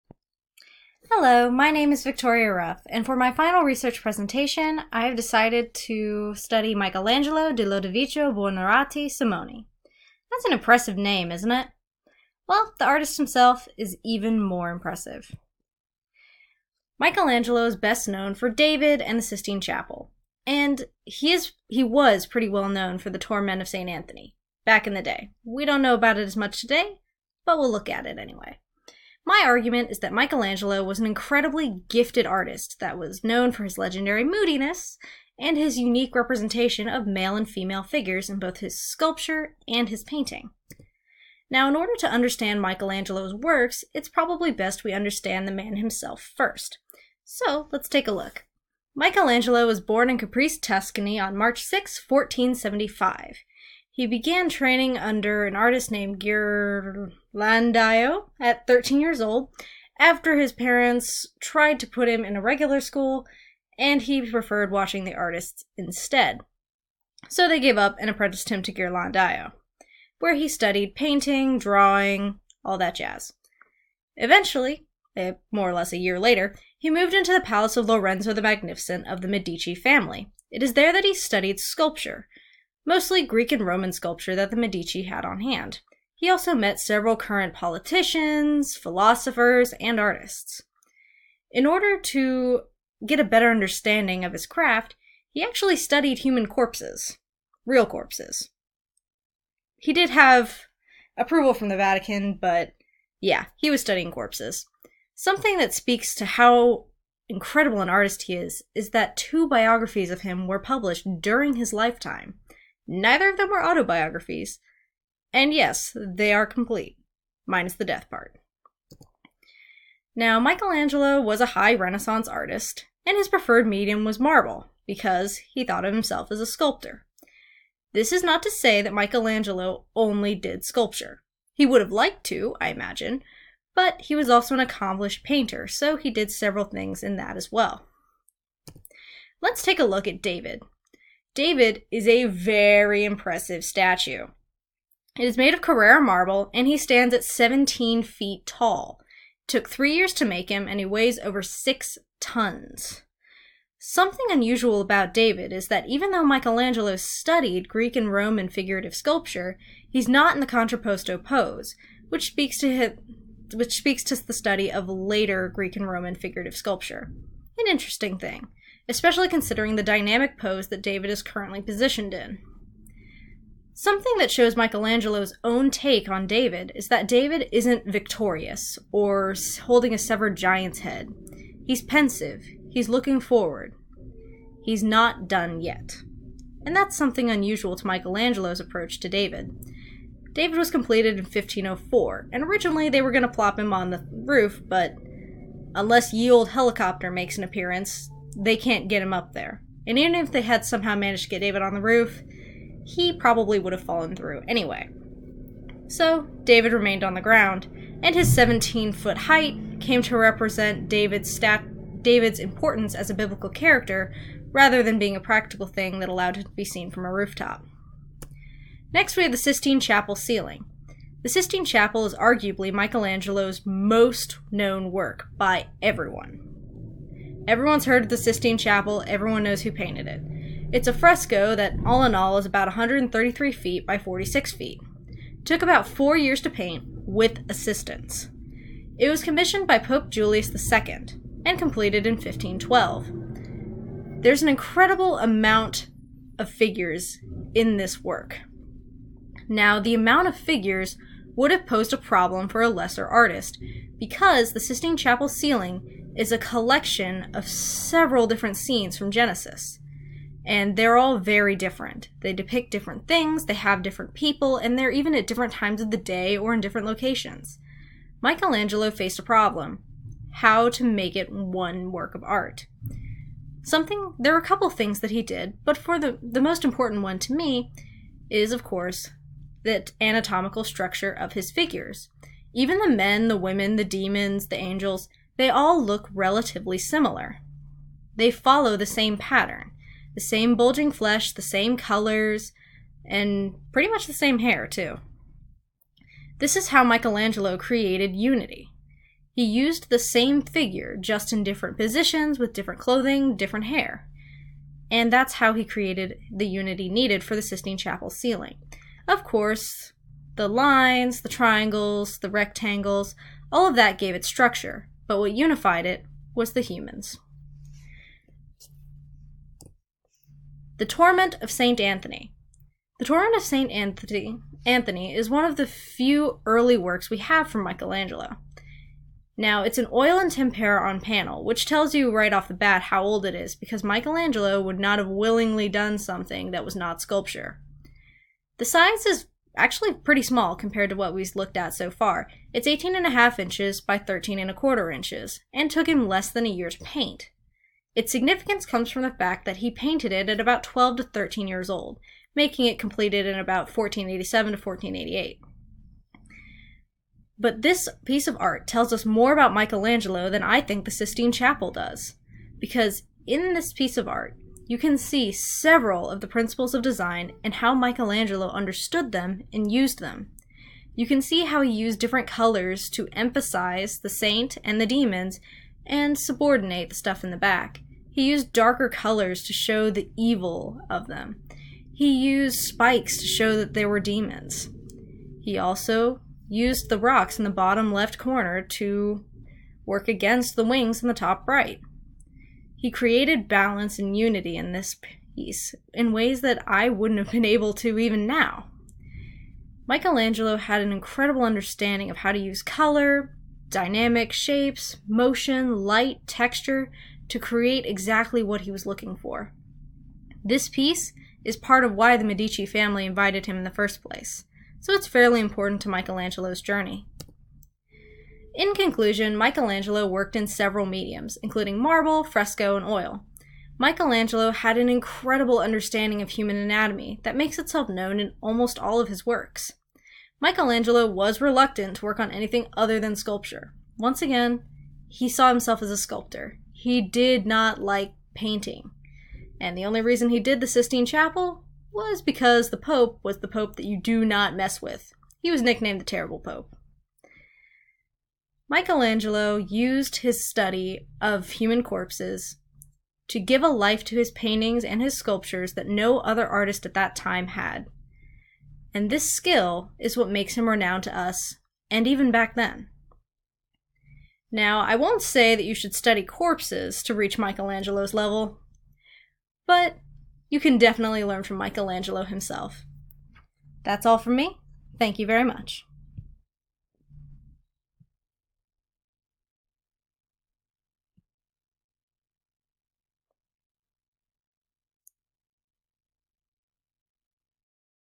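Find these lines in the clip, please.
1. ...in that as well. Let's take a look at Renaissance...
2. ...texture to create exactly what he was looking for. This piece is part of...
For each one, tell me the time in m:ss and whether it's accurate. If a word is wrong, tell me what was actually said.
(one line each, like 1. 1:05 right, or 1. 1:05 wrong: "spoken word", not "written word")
1. 2:17 wrong: "David", not "Renaissance"
2. 6:46 right.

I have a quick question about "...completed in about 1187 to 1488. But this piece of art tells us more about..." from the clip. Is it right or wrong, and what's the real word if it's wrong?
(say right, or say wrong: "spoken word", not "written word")
wrong: "1487", not "1187".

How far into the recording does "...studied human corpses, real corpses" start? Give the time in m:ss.
1:35.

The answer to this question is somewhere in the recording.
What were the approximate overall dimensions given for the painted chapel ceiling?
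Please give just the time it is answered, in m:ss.
3:52.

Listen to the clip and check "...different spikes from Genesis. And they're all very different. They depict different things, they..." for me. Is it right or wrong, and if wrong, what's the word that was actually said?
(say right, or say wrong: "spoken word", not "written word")
wrong: "scenes", not "spikes".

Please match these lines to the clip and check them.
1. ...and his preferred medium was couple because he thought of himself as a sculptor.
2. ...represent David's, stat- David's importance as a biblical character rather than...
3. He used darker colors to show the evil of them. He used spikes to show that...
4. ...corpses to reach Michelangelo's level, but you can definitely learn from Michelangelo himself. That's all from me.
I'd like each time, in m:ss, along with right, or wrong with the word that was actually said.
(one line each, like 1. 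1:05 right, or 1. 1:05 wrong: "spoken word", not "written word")
1. 2:03 wrong: "marble", not "couple"
2. 3:30 right
3. 6:18 right
4. 7:46 right.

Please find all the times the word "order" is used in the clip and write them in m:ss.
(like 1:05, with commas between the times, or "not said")
0:41, 1:31.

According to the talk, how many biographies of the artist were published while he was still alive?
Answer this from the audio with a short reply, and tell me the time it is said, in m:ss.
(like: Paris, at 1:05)
2, at 1:49.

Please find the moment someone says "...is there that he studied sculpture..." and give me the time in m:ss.
1:20.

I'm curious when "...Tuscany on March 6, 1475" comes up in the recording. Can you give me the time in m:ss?
0:50.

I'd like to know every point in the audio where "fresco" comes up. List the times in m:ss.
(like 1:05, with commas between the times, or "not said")
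3:50, 7:02.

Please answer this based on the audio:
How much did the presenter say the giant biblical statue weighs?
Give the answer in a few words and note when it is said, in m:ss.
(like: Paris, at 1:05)
over 6 tons, at 2:31.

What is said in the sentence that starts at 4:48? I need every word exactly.
They follow the same pattern the same bulging flesh, the same colors, and pretty much the same hair, too.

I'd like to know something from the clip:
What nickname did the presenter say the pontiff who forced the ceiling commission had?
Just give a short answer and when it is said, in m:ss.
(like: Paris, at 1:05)
the Terrible Pope, at 7:26.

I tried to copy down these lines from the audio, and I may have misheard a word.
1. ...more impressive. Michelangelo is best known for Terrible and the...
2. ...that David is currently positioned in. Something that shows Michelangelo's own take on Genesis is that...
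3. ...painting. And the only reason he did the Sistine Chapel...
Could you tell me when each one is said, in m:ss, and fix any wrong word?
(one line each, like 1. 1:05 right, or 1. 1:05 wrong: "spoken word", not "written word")
1. 0:14 wrong: "David", not "Terrible"
2. 2:50 wrong: "David", not "Genesis"
3. 7:18 right.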